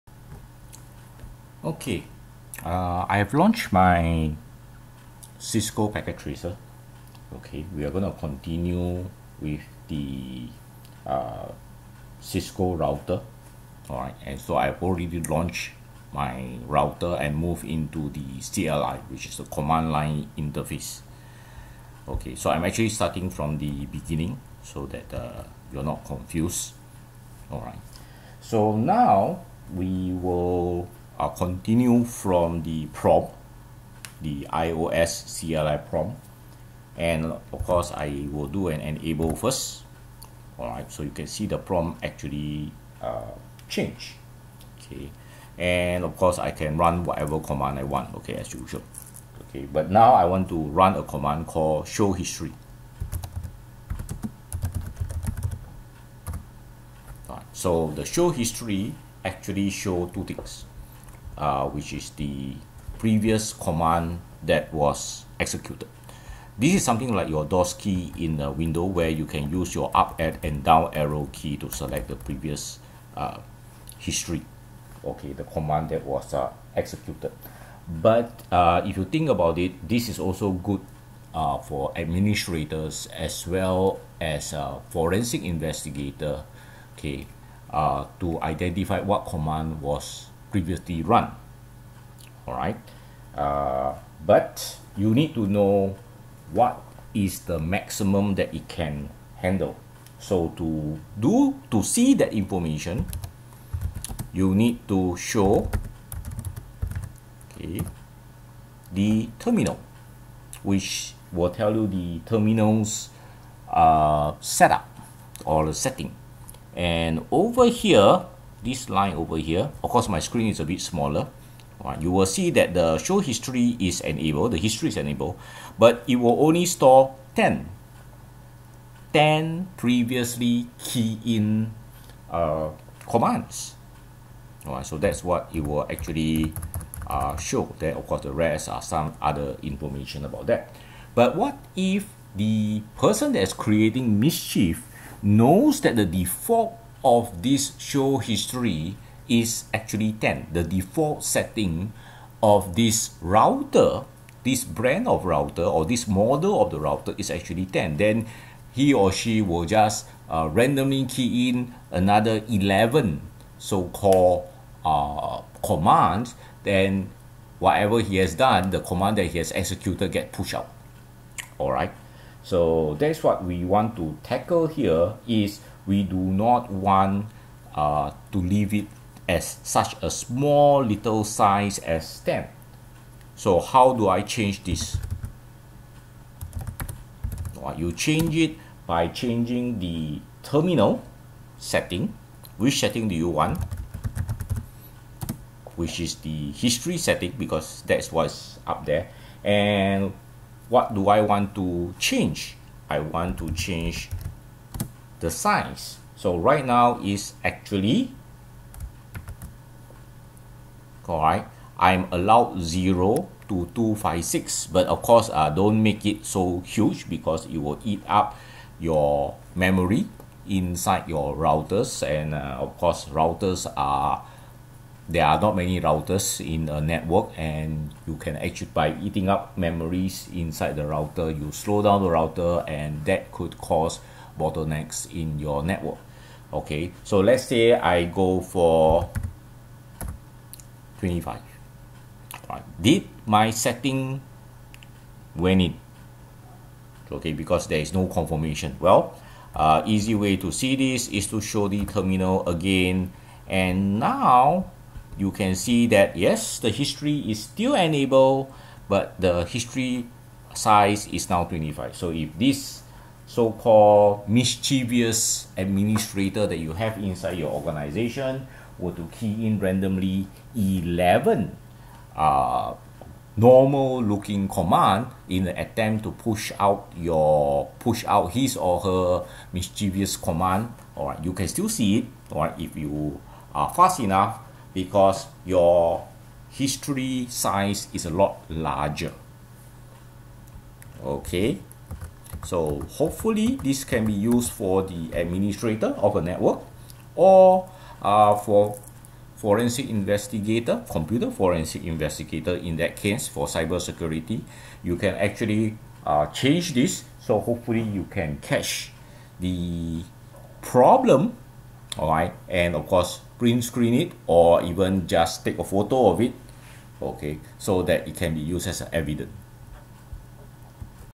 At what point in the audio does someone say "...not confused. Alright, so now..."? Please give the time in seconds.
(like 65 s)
25 s.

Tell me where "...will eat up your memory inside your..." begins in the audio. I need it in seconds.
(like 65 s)
217 s.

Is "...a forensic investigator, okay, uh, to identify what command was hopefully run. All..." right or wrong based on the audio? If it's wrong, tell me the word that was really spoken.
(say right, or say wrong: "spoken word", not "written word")
wrong: "previously", not "hopefully".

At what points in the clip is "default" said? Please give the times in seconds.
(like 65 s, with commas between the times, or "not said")
146 s, 150 s.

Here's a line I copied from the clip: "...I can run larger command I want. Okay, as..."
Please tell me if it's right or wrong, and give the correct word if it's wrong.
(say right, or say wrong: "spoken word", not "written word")
wrong: "whatever", not "larger".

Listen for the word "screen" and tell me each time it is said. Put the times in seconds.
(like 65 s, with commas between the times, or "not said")
120 s, 313 s.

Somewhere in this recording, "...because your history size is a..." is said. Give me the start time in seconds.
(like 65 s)
284 s.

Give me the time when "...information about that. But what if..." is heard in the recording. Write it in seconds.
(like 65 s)
139 s.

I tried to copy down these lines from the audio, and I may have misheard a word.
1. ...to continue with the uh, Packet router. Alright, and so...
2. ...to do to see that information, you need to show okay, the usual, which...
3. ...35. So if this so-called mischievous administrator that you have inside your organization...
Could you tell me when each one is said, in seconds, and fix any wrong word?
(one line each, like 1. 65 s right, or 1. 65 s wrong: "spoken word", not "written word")
1. 8 s wrong: "Cisco", not "Packet"
2. 100 s wrong: "terminal", not "usual"
3. 261 s wrong: "25", not "35".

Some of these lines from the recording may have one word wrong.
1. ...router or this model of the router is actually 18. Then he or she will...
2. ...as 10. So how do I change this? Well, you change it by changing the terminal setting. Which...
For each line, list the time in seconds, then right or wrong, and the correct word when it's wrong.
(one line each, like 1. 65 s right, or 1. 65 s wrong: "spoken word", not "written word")
1. 155 s wrong: "10", not "18"
2. 181 s right.